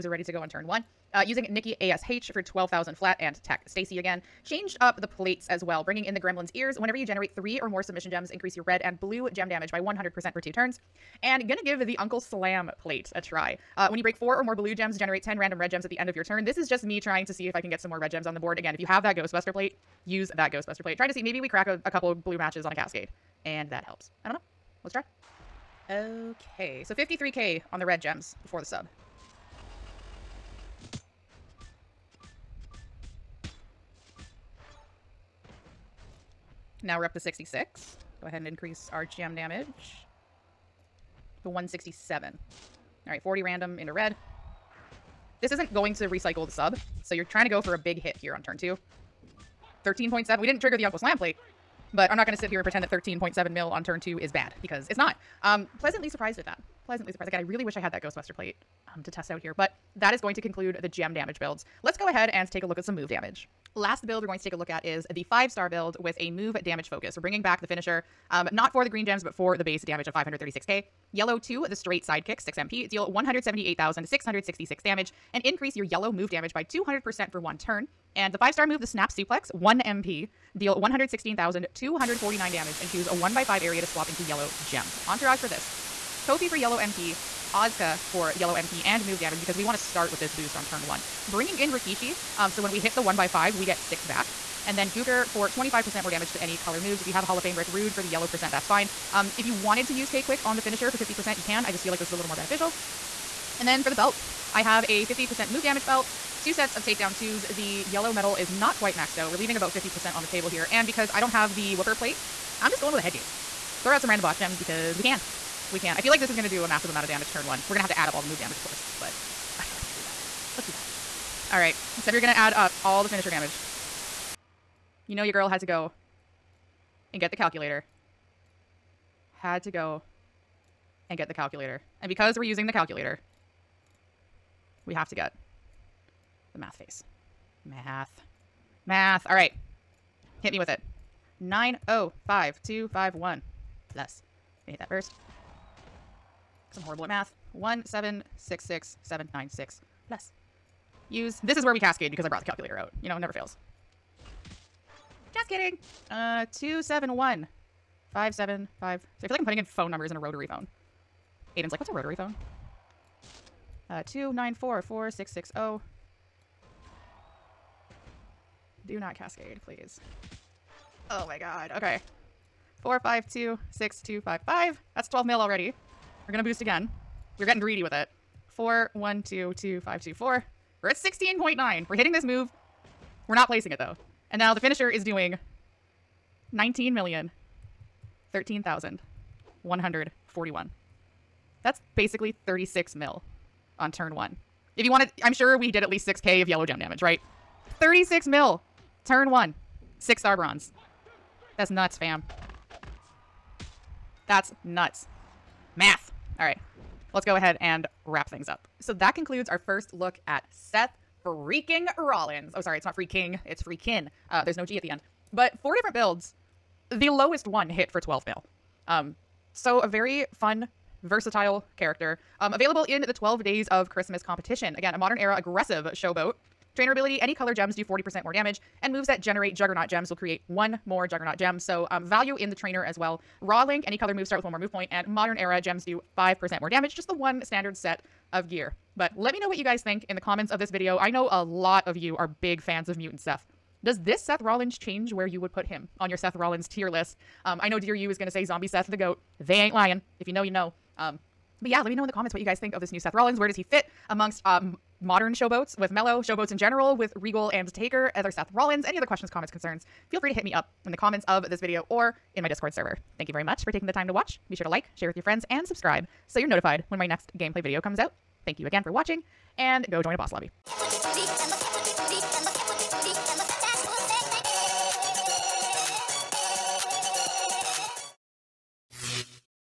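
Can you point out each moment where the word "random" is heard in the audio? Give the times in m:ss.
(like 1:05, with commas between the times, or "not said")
0:15, 0:43, 1:54.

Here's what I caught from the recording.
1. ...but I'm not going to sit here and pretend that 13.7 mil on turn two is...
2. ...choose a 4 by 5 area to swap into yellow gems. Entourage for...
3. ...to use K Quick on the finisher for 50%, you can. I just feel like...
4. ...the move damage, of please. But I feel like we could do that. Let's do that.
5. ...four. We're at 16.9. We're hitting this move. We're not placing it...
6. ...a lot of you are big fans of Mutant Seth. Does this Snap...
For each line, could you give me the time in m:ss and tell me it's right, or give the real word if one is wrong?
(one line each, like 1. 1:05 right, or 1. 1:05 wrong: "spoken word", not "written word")
1. 0:51 right
2. 1:22 wrong: "1", not "4"
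3. 1:39 right
4. 1:58 wrong: "course", not "please"
5. 3:00 right
6. 4:01 wrong: "Seth", not "Snap".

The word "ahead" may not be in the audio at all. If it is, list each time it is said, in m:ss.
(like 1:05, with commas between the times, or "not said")
0:38, 1:02, 3:27.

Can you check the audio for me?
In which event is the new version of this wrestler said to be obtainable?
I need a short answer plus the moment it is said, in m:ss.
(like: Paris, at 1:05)
12 Days of Christmas, at 3:43.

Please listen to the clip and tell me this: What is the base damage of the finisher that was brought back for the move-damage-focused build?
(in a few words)
536k.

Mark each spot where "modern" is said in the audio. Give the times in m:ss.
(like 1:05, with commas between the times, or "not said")
3:44, 3:55, 4:15.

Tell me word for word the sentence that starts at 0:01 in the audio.
Uh, using Nikki ASH for 12,000 flat and Tech Stacy again.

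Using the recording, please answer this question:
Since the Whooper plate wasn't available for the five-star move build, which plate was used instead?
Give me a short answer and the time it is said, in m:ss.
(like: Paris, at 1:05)
Head Games, at 1:53.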